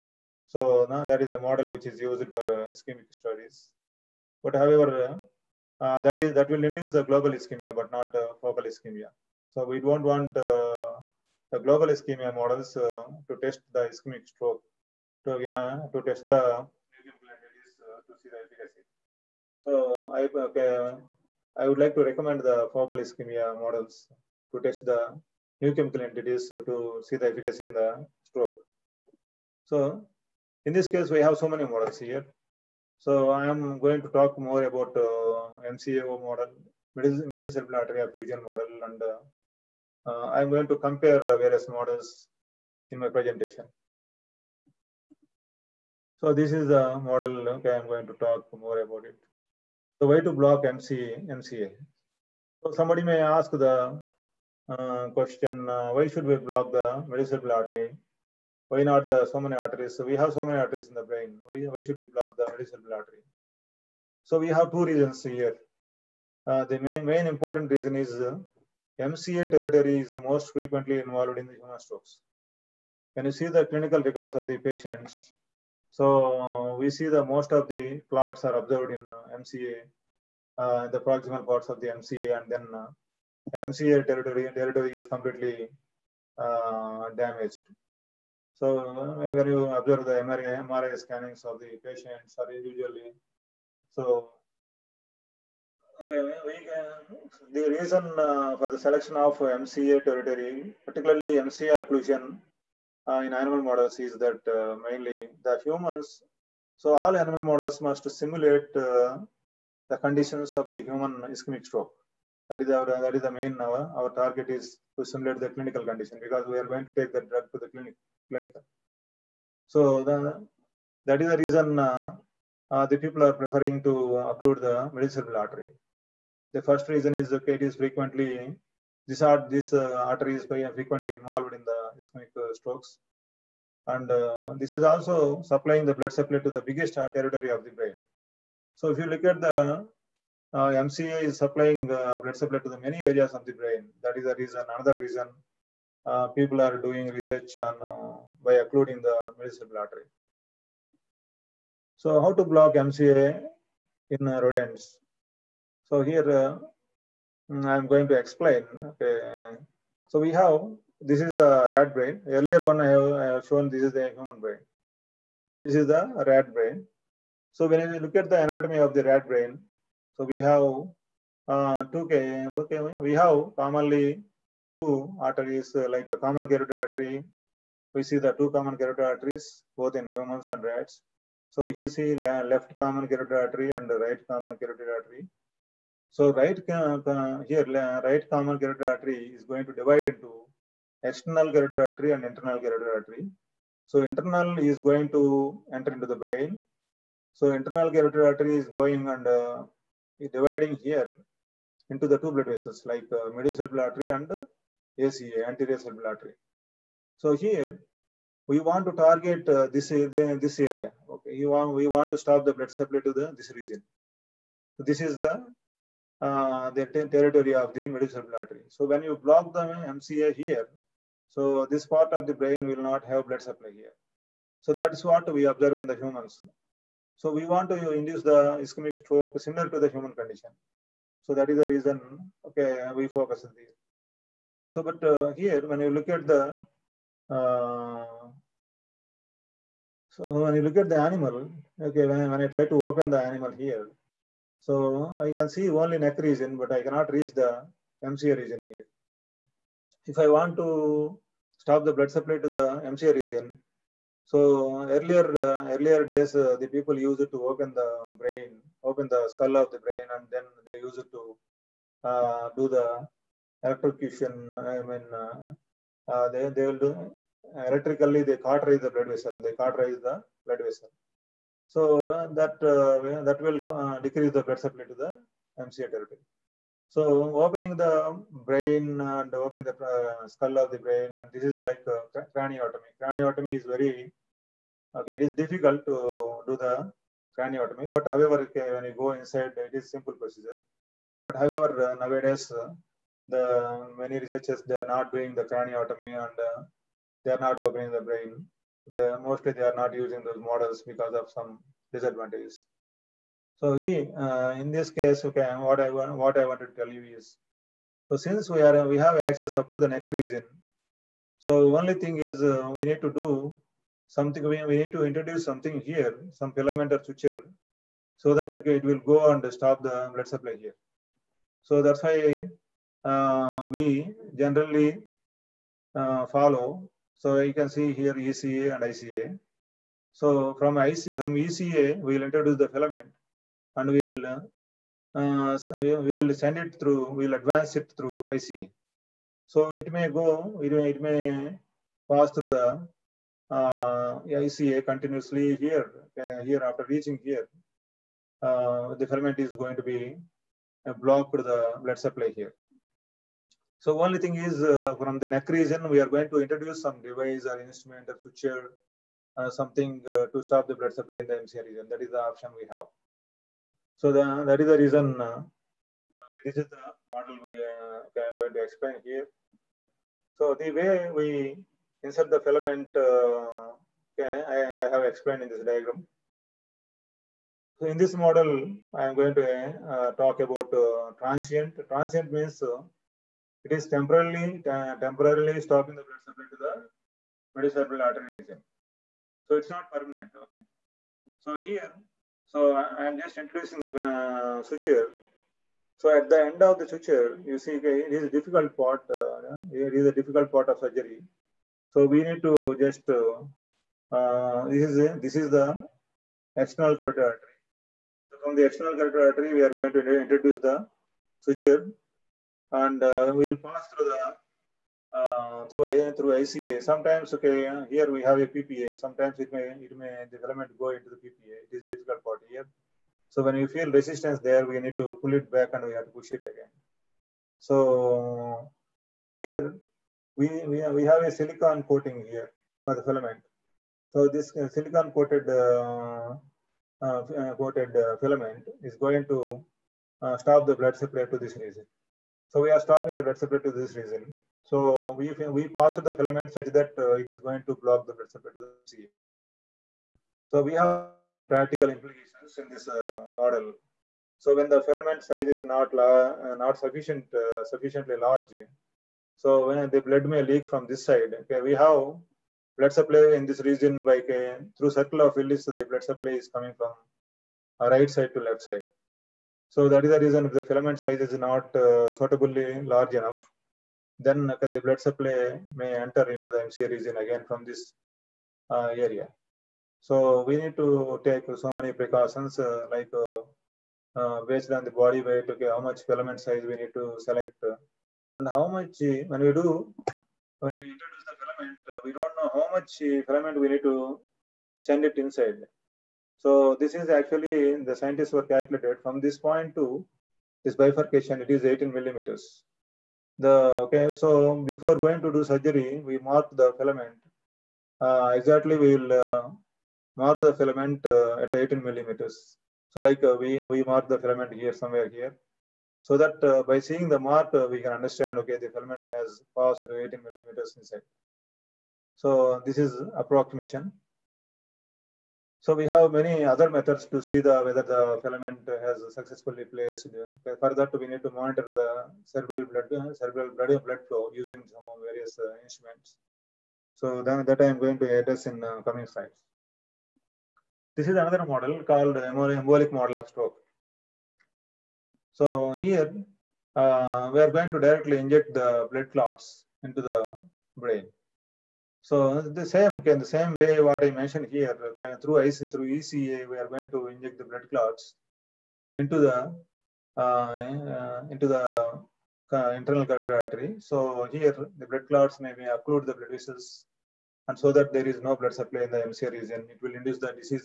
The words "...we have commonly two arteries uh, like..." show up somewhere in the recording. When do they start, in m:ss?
2:53.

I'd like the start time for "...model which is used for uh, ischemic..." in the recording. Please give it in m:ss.
0:01.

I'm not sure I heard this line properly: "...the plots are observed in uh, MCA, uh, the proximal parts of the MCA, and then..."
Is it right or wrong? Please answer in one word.
right.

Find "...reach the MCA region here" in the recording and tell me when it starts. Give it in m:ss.
4:07.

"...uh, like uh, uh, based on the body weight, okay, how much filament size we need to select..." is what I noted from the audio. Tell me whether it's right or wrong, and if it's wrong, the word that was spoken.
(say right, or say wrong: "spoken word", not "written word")
right.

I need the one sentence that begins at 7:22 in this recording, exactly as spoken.
So we are stopping the blood supply to this region.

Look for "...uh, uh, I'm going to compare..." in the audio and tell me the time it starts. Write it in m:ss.
0:39.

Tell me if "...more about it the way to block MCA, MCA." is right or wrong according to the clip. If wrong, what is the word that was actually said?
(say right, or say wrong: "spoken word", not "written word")
right.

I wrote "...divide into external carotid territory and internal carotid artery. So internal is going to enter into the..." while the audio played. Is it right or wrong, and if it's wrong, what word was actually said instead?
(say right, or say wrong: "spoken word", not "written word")
wrong: "artery", not "territory".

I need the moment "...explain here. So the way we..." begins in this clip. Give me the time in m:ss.
6:08.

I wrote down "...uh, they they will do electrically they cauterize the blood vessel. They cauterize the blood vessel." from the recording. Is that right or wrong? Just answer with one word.
right.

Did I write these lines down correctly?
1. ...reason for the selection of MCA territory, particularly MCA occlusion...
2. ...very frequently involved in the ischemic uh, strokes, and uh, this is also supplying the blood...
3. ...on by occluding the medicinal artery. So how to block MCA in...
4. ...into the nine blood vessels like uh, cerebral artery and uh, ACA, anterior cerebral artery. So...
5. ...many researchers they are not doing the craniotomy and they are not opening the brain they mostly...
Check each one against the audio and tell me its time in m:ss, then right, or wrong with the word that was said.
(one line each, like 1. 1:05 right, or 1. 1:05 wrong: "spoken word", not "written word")
1. 1:37 right
2. 2:10 right
3. 2:27 right
4. 3:21 wrong: "two", not "nine"
5. 4:54 right.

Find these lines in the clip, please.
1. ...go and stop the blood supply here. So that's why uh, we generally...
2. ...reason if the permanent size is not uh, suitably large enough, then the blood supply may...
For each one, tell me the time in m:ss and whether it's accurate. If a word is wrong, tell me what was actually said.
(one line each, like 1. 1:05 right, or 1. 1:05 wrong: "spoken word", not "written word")
1. 5:18 right
2. 7:50 wrong: "filament", not "permanent".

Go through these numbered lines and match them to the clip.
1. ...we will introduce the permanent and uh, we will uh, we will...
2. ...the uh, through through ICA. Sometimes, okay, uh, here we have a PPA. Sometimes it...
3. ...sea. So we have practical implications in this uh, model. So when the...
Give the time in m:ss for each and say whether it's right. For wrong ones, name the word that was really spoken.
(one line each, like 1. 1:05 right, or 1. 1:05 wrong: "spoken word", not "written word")
1. 5:32 wrong: "filament", not "permanent"
2. 6:54 right
3. 7:28 right.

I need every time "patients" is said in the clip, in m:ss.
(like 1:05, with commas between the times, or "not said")
1:14, 1:31.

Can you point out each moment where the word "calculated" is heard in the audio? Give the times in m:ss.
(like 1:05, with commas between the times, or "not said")
8:18.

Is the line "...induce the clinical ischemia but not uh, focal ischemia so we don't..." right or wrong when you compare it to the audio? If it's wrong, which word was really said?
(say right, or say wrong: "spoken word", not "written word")
wrong: "global", not "clinical".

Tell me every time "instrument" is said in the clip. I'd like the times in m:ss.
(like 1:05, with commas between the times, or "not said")
5:57, 8:55.